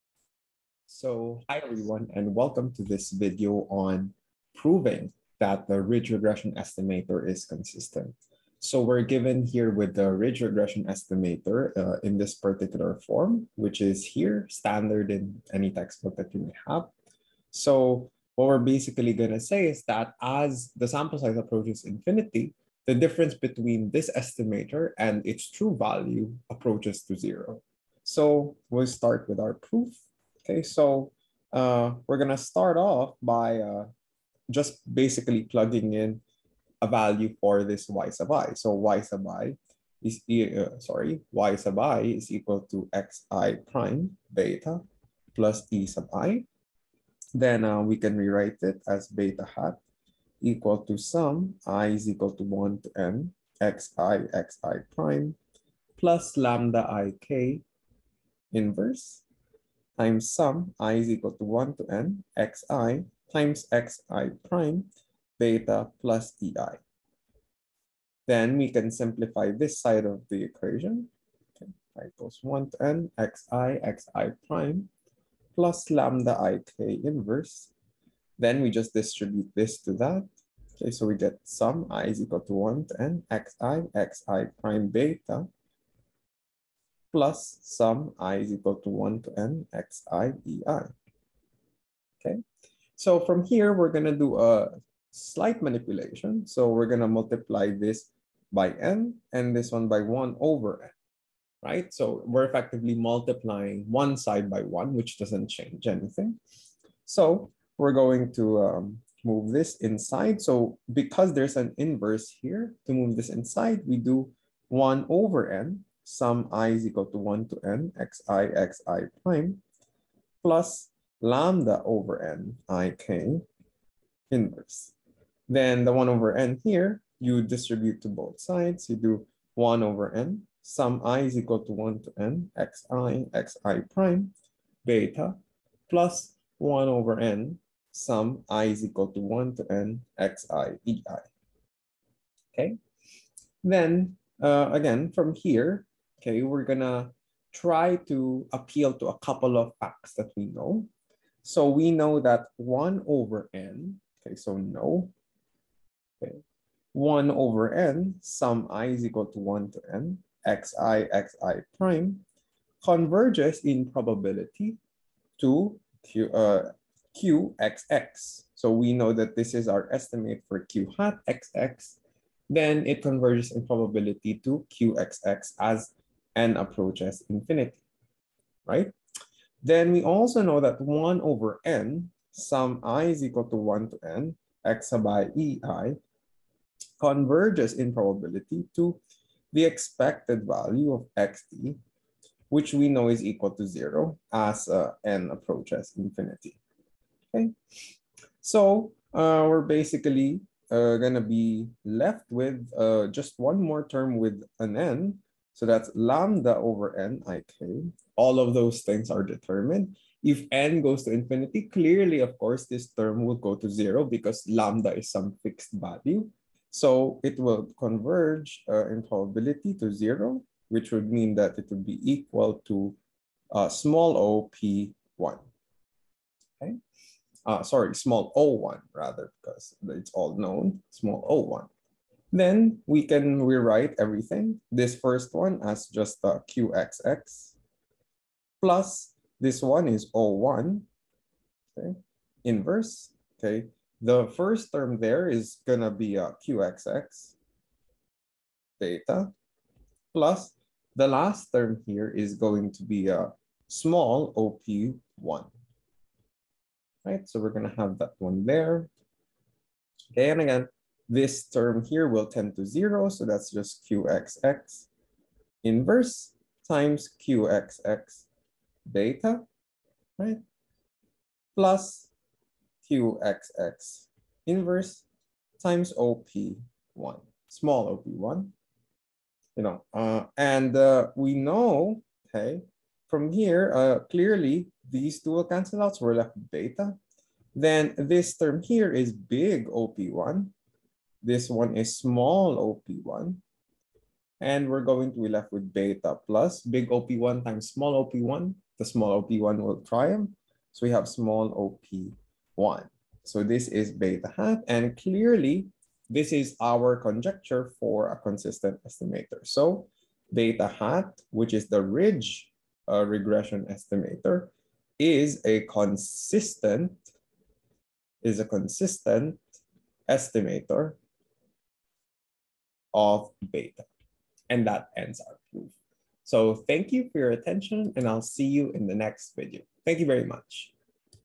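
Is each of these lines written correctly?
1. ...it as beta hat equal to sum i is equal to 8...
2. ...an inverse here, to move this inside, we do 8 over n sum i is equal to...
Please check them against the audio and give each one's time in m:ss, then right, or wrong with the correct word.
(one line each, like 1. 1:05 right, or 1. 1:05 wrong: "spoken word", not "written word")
1. 0:48 wrong: "1", not "8"
2. 1:51 wrong: "1", not "8".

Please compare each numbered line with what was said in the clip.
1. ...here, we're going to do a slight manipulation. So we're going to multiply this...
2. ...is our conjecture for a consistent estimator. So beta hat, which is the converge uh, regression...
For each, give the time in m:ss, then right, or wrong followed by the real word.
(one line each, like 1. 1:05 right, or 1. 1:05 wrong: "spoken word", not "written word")
1. 1:33 right
2. 5:06 wrong: "ridge", not "converge".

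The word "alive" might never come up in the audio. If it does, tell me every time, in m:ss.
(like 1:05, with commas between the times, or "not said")
not said.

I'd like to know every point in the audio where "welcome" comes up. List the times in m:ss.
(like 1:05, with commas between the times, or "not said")
0:02.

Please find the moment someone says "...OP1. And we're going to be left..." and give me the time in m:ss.
4:52.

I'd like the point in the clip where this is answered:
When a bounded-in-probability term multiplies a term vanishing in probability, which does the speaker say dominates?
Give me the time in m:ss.
4:58.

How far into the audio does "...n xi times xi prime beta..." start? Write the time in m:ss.
1:01.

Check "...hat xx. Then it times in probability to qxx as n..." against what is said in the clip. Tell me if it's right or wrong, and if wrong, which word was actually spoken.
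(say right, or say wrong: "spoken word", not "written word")
wrong: "converges", not "times".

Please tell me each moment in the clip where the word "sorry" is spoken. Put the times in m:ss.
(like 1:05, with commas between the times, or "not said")
0:40, 3:47.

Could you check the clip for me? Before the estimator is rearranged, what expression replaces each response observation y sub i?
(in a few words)
xi prime beta plus e sub i.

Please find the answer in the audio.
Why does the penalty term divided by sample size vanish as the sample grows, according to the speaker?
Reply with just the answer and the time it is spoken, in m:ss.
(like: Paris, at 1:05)
lambda is some fixed value, at 3:34.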